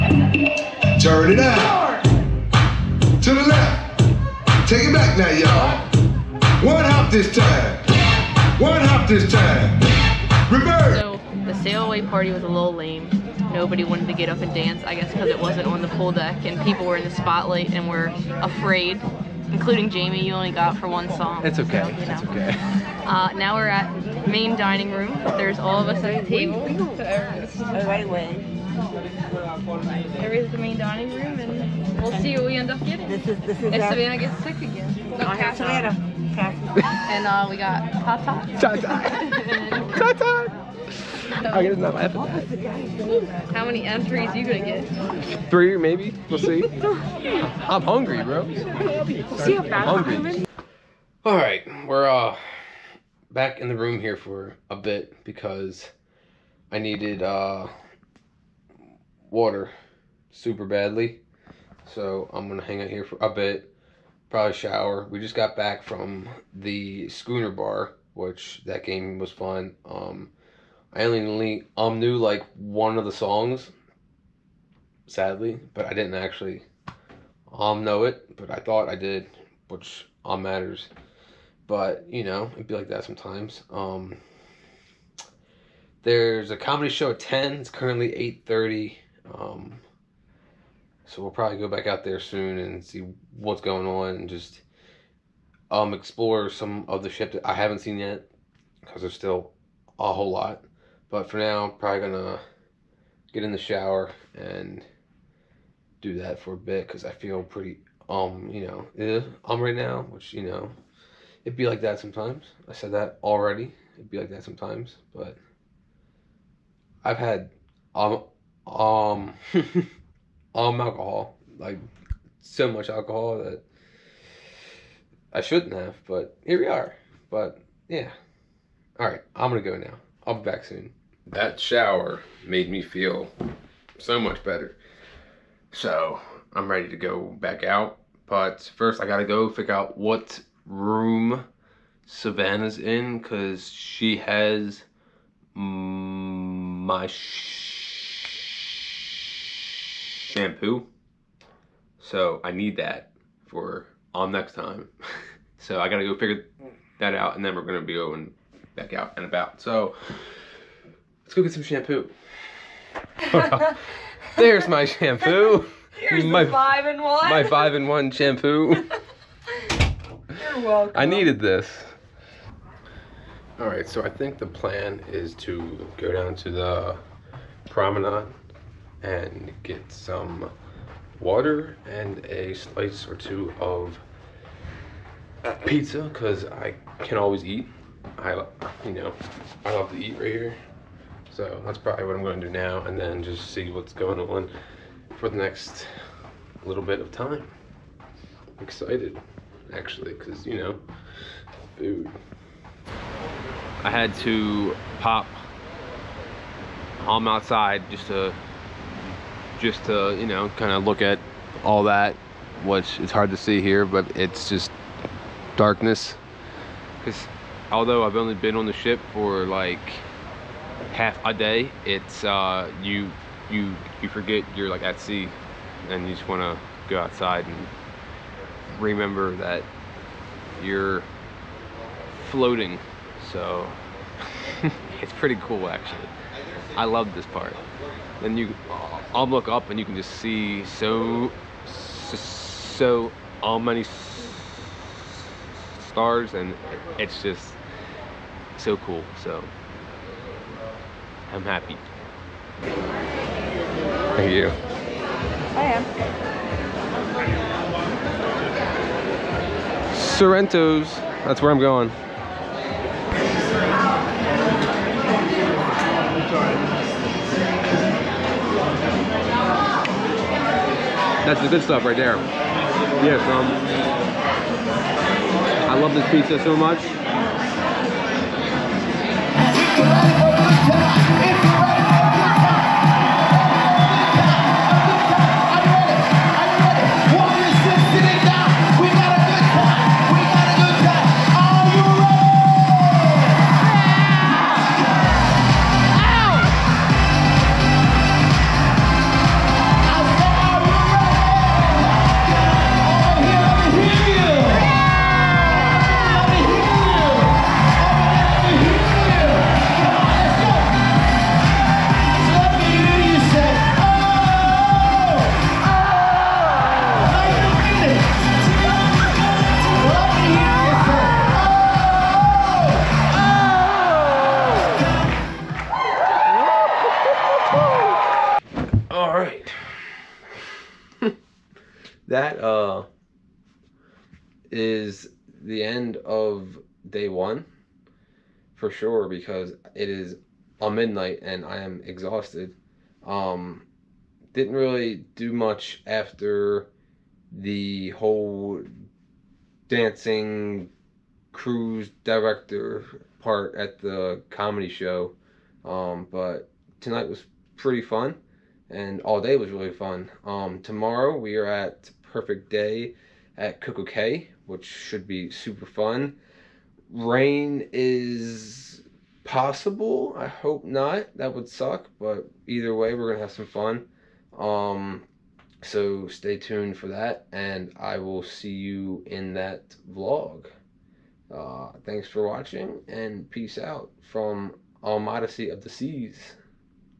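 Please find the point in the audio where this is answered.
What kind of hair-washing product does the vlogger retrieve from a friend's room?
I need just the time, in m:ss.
2:47.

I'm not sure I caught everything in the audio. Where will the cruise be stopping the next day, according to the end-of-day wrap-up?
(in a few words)
Perfect Day at CocoCay.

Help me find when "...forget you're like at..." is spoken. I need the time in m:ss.
3:44.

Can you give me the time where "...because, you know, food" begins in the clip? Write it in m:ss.
3:20.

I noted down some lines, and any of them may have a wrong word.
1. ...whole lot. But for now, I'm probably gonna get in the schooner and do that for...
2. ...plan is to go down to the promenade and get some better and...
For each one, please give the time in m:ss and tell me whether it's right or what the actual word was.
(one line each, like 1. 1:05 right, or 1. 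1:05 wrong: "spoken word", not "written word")
1. 1:40 wrong: "shower", not "schooner"
2. 2:54 wrong: "water", not "better".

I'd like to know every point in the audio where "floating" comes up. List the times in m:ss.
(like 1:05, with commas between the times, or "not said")
3:52.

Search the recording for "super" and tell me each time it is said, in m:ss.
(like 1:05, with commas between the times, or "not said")
1:00, 6:05.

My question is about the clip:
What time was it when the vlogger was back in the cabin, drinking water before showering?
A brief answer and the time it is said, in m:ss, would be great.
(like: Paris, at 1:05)
8:30, at 1:28.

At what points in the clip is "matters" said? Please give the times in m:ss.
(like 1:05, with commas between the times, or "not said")
1:20.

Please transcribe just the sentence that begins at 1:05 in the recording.
We just got back from the schooner bar, which that game was fun.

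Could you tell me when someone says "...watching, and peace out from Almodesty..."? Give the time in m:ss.
6:22.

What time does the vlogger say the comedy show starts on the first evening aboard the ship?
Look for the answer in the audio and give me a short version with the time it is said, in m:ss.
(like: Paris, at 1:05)
10, at 1:27.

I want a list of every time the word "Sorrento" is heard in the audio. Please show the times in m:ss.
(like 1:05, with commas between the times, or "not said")
4:19.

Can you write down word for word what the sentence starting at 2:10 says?
I'll be back soon that shower made me feel so much better.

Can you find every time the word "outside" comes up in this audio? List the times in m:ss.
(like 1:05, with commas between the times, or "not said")
3:27, 3:46.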